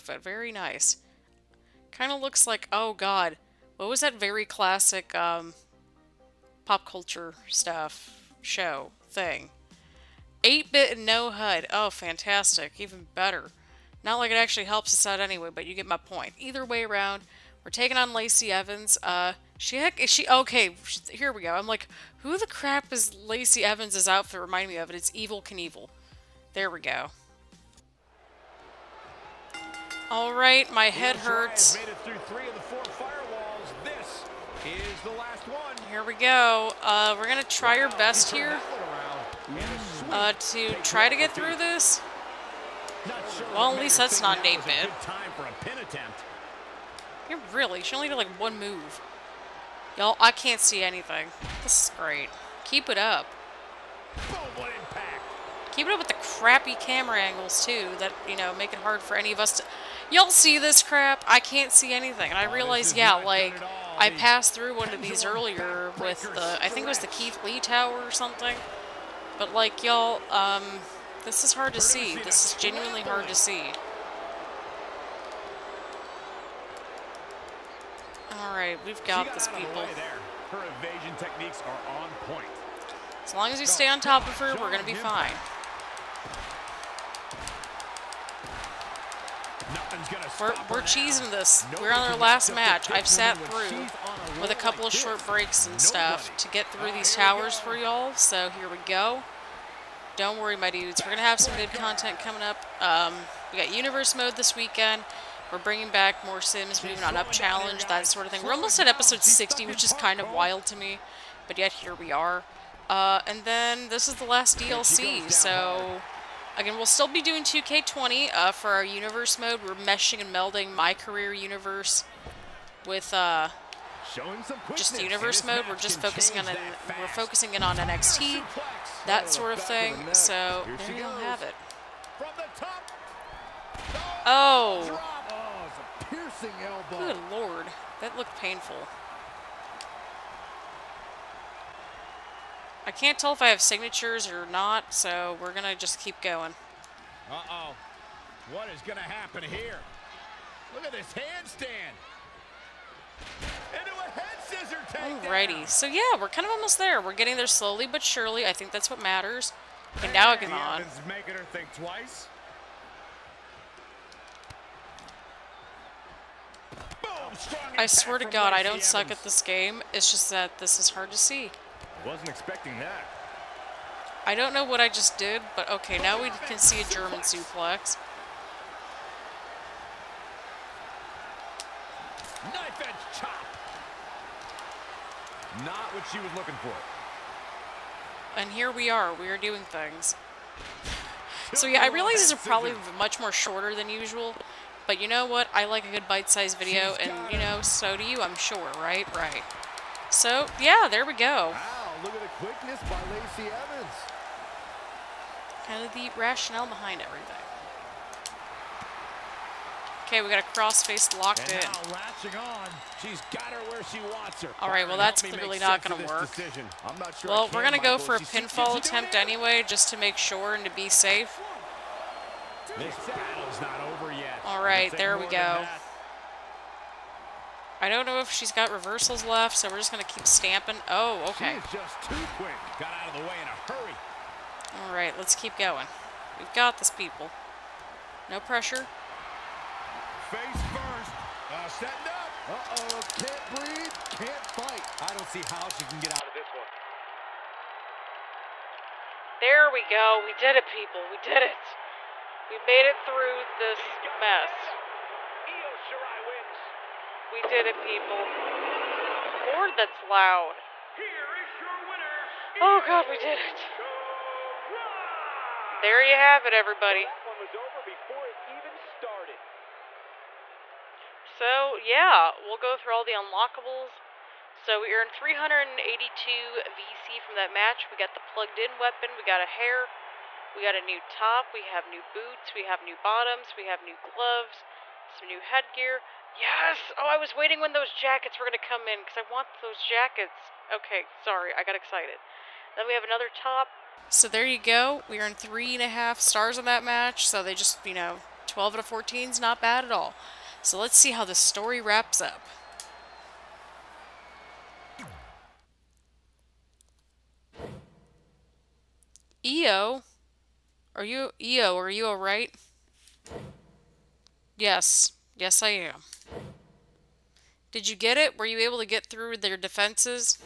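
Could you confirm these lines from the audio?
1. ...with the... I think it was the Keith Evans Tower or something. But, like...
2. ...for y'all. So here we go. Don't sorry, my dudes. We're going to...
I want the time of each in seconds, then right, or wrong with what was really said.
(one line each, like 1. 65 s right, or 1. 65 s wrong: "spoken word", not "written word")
1. 66 s wrong: "Lee", not "Evans"
2. 97 s wrong: "worry", not "sorry".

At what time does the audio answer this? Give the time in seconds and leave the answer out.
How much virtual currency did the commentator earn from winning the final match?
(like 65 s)
275 s.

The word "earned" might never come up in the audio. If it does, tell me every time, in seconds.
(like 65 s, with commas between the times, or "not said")
274 s, 295 s.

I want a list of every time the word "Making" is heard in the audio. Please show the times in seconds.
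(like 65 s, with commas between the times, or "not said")
161 s.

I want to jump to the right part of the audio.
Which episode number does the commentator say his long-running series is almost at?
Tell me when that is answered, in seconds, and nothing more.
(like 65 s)
108 s.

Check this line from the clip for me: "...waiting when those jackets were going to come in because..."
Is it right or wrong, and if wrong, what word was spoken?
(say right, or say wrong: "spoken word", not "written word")
right.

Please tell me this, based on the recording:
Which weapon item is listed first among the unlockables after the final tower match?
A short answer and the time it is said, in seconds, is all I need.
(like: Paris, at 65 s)
plugged in weapon, at 278 s.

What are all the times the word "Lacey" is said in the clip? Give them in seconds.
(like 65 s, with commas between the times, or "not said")
18 s, 23 s, 203 s.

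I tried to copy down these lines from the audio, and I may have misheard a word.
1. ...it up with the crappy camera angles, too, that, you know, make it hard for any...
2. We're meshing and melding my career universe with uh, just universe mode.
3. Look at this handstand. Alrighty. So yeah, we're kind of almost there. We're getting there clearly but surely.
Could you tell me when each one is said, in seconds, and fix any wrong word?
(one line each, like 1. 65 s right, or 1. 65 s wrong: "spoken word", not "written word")
1. 55 s right
2. 119 s right
3. 150 s wrong: "slowly", not "clearly".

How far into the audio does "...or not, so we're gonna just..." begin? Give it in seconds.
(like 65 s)
144 s.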